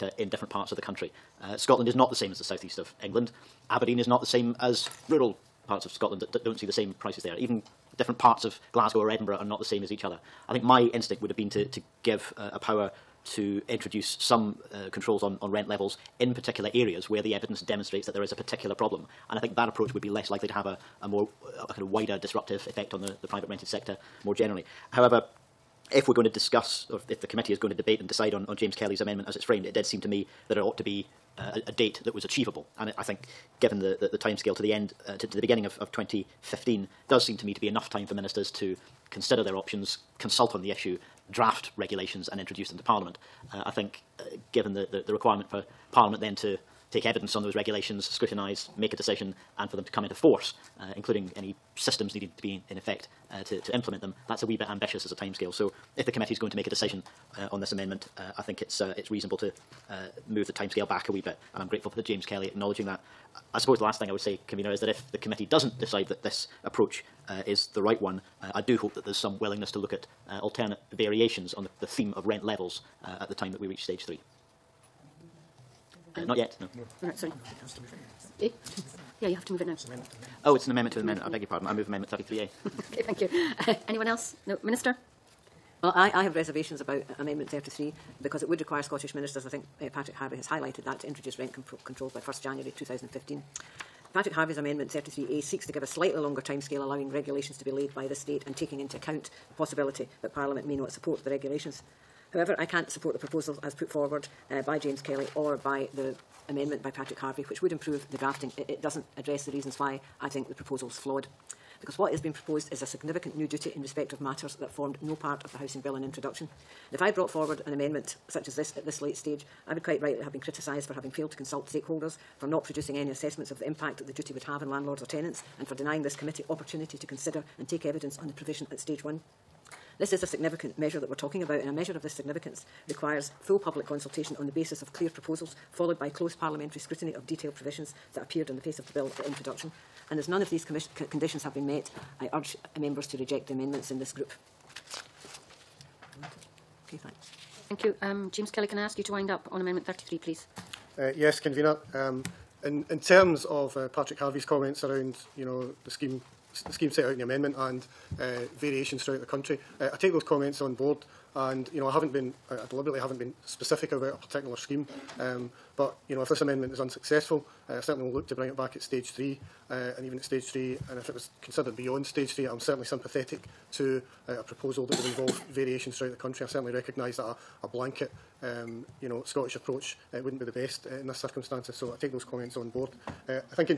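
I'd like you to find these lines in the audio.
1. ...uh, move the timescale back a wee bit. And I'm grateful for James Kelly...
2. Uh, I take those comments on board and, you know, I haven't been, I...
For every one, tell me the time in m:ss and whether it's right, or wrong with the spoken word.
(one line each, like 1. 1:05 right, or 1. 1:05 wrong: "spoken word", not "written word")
1. 0:59 right
2. 2:39 right.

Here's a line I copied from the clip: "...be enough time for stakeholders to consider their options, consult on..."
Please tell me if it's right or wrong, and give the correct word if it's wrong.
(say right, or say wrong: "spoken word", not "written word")
wrong: "ministers", not "stakeholders".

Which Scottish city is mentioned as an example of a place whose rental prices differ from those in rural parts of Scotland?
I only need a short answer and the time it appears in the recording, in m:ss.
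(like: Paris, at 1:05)
Aberdeen, at 0:03.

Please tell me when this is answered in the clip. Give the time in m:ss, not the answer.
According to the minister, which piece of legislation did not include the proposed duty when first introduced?
1:55.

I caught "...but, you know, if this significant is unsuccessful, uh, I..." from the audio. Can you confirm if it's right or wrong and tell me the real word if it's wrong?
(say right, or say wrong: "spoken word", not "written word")
wrong: "amendment", not "significant".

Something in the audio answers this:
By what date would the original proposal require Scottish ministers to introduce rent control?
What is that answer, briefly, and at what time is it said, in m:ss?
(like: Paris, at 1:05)
1 January 2015, at 1:32.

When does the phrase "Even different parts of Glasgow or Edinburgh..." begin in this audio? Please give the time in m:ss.
0:07.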